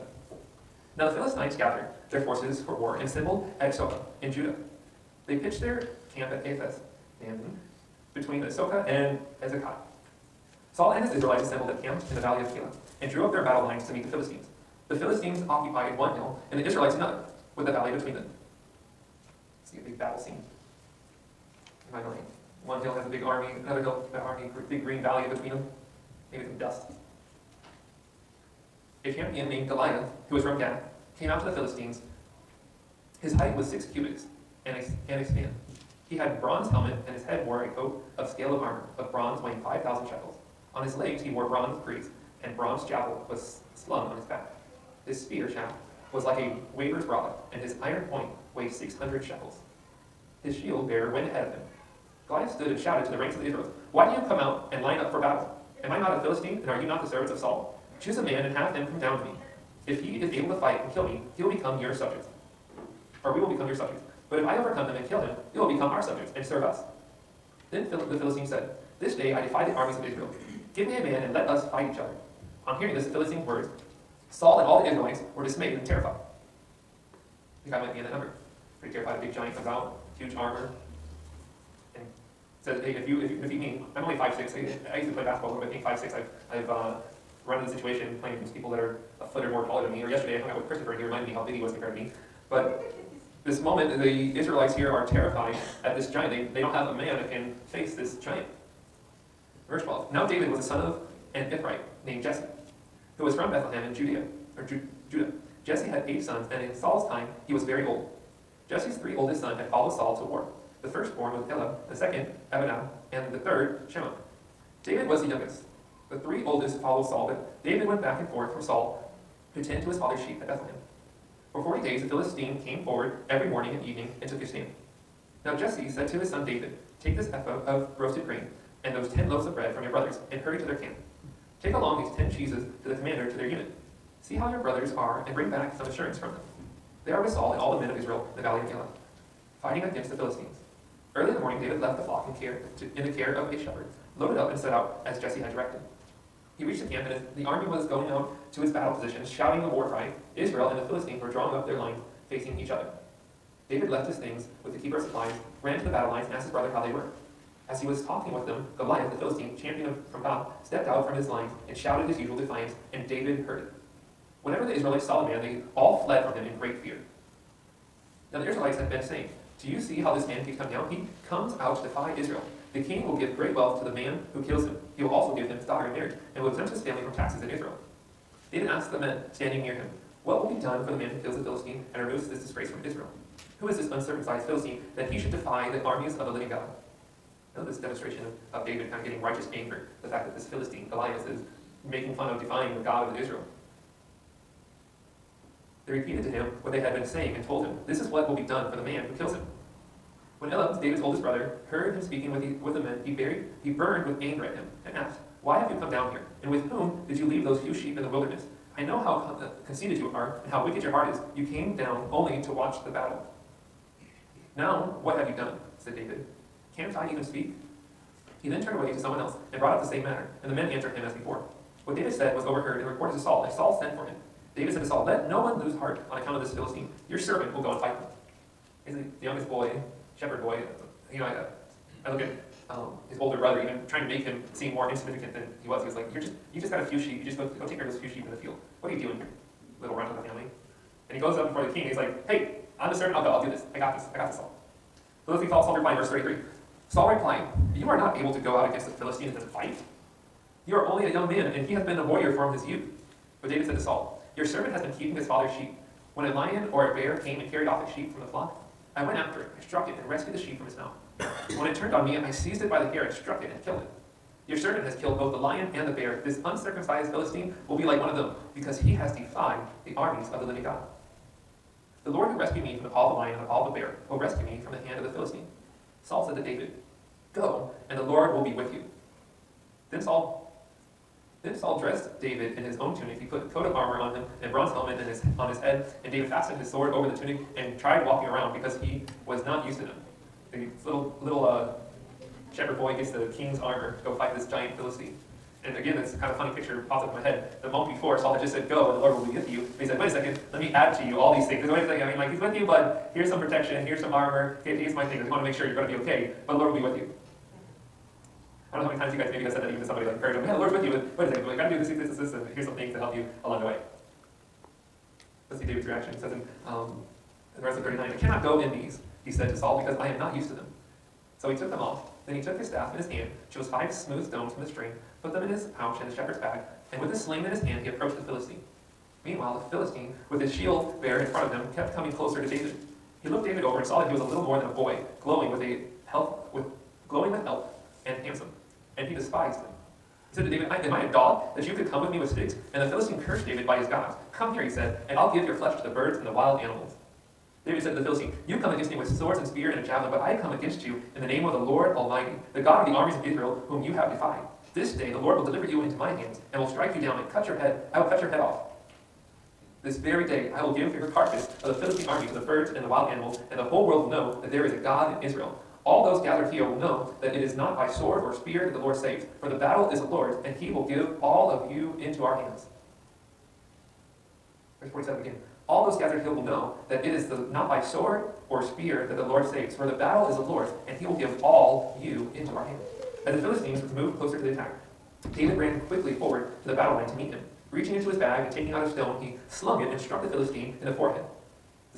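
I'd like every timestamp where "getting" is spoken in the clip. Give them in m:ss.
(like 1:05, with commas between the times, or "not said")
3:09.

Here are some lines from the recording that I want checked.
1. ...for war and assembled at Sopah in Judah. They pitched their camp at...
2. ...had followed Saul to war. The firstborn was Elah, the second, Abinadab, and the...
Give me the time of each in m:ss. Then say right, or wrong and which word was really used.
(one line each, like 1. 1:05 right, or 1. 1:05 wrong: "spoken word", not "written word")
1. 0:02 right
2. 1:49 right.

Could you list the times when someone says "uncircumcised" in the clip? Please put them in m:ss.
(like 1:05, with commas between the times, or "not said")
3:03, 4:26.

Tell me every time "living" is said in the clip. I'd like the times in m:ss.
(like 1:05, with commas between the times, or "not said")
3:06, 4:30.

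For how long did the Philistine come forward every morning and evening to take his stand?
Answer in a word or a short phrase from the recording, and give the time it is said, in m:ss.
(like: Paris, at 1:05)
40 days, at 2:01.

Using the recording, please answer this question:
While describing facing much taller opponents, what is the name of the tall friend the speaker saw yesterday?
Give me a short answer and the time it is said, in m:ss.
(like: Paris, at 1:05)
Christopher, at 1:30.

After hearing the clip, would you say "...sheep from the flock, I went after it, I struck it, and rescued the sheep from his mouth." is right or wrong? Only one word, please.
right.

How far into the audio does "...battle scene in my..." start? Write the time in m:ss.
0:19.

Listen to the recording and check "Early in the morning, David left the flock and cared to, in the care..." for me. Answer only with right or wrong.
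right.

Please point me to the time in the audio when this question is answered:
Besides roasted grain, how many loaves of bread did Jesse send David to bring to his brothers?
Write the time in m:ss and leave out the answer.
2:09.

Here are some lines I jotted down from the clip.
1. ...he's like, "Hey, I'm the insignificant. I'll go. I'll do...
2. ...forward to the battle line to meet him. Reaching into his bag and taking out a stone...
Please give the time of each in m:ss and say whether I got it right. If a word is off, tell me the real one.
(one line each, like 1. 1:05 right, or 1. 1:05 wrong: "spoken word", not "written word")
1. 4:01 wrong: "servant", not "insignificant"
2. 6:26 right.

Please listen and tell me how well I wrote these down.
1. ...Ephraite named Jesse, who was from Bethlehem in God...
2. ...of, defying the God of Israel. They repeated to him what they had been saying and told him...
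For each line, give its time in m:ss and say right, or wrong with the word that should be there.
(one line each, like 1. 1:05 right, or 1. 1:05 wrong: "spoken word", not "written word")
1. 1:41 wrong: "Judea", not "God"
2. 3:12 right.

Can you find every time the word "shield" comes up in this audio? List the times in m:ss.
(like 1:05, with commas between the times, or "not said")
0:50, 5:30.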